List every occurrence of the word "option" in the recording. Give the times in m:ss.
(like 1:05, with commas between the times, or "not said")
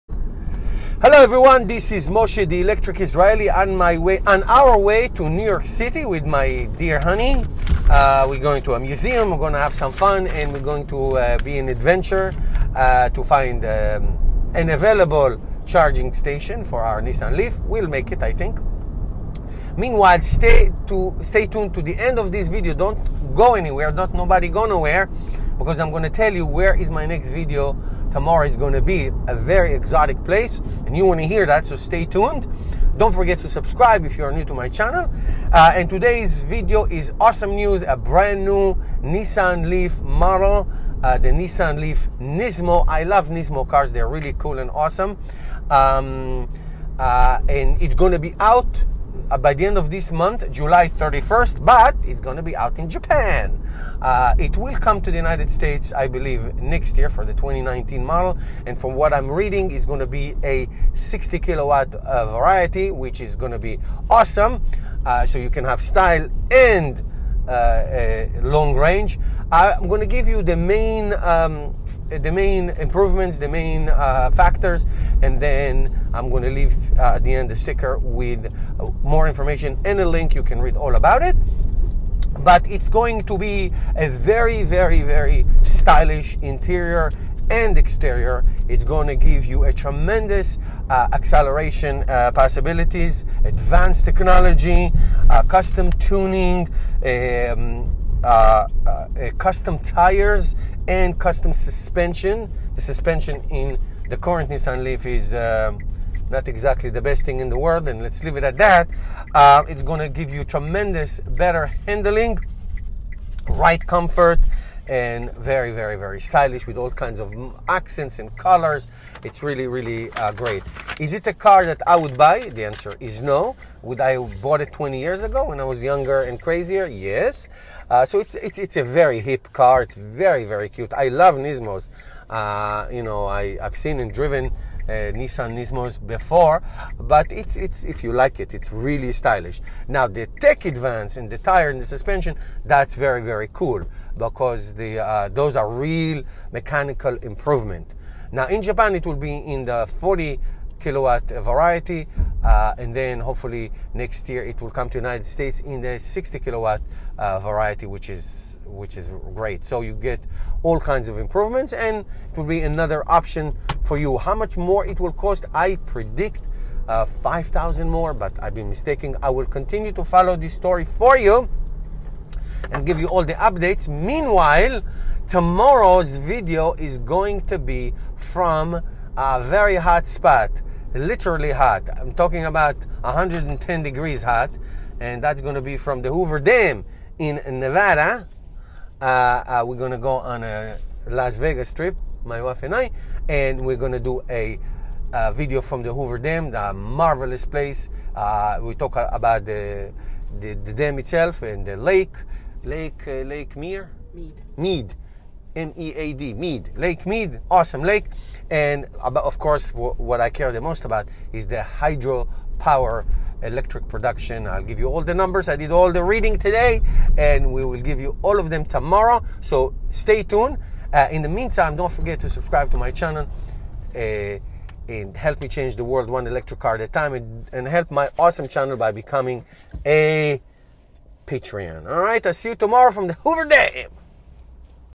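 2:43.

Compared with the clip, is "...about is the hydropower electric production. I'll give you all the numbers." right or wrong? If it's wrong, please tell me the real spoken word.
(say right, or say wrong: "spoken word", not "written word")
right.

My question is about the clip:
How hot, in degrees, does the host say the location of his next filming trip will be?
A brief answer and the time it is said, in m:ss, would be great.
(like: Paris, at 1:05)
110 degrees, at 3:03.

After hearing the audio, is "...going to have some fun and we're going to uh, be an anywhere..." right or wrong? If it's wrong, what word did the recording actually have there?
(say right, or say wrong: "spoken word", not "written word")
wrong: "adventure", not "anywhere".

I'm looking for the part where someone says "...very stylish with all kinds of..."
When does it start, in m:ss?
1:55.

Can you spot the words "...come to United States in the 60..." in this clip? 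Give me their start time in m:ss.
2:34.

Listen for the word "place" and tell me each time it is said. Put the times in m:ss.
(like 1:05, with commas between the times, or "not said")
0:30, 3:17.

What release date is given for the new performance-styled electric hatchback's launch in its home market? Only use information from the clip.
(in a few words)
July 31st.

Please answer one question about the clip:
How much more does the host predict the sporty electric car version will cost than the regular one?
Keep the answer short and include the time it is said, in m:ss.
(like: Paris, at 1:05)
5,000, at 2:47.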